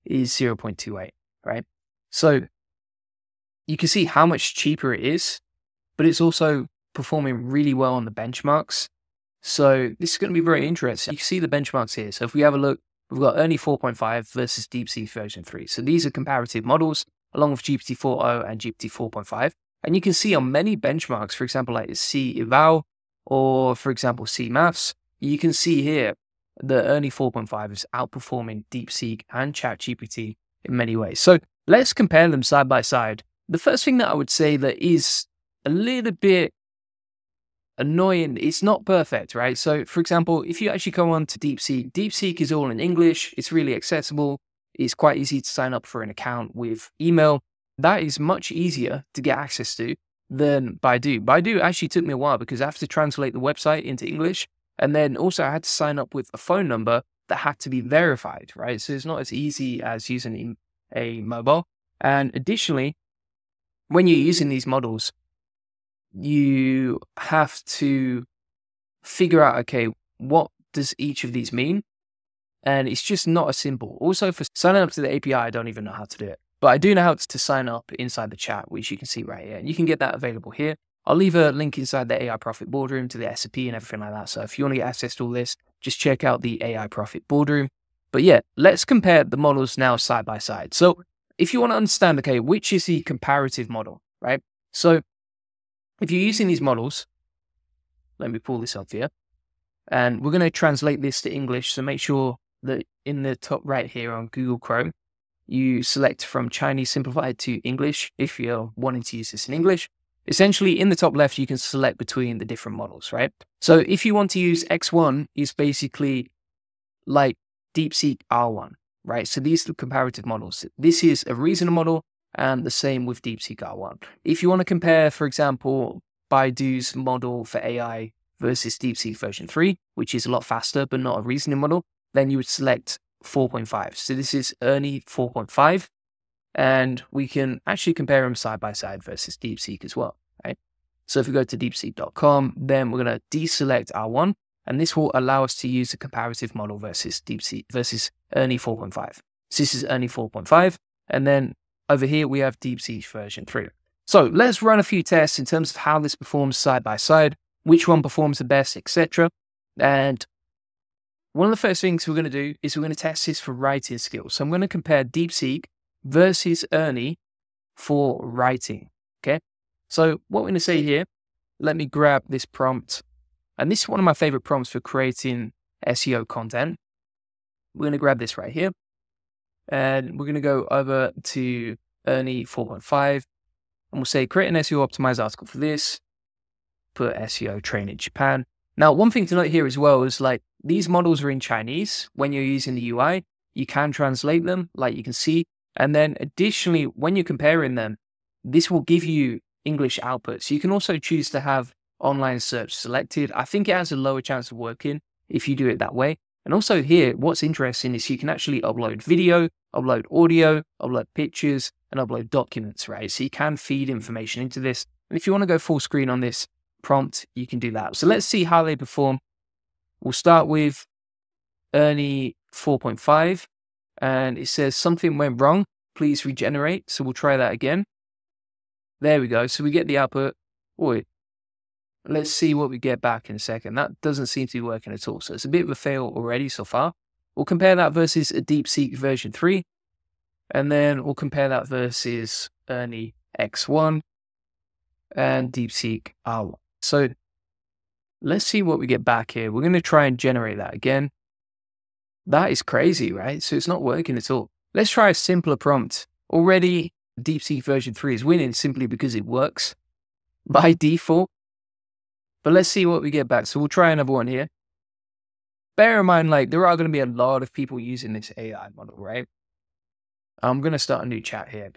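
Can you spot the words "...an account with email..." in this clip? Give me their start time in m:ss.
0:46.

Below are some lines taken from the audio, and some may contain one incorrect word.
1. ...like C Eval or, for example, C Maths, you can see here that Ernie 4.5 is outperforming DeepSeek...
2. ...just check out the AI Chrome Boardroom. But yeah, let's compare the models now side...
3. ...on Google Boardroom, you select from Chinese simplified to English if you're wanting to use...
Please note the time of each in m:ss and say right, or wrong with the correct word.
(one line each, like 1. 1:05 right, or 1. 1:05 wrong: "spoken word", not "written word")
1. 0:21 right
2. 1:25 wrong: "Profit", not "Chrome"
3. 1:44 wrong: "Chrome", not "Boardroom".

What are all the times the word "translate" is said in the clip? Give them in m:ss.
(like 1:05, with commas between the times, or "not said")
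0:52, 1:40, 3:13.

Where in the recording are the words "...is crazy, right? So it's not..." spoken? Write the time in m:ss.
4:12.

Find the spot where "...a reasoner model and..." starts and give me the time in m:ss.
2:01.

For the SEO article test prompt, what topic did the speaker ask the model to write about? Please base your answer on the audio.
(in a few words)
Train in Japan.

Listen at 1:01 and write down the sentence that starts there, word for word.
And additionally, when you're using these models, you have to figure out, okay, what does each of these mean?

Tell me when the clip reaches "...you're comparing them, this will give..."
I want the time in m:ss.
3:17.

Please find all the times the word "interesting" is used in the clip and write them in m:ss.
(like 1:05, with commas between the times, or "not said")
0:10, 3:27.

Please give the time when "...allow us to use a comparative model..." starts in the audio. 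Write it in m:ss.
2:25.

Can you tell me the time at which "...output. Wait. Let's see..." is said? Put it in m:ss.
3:49.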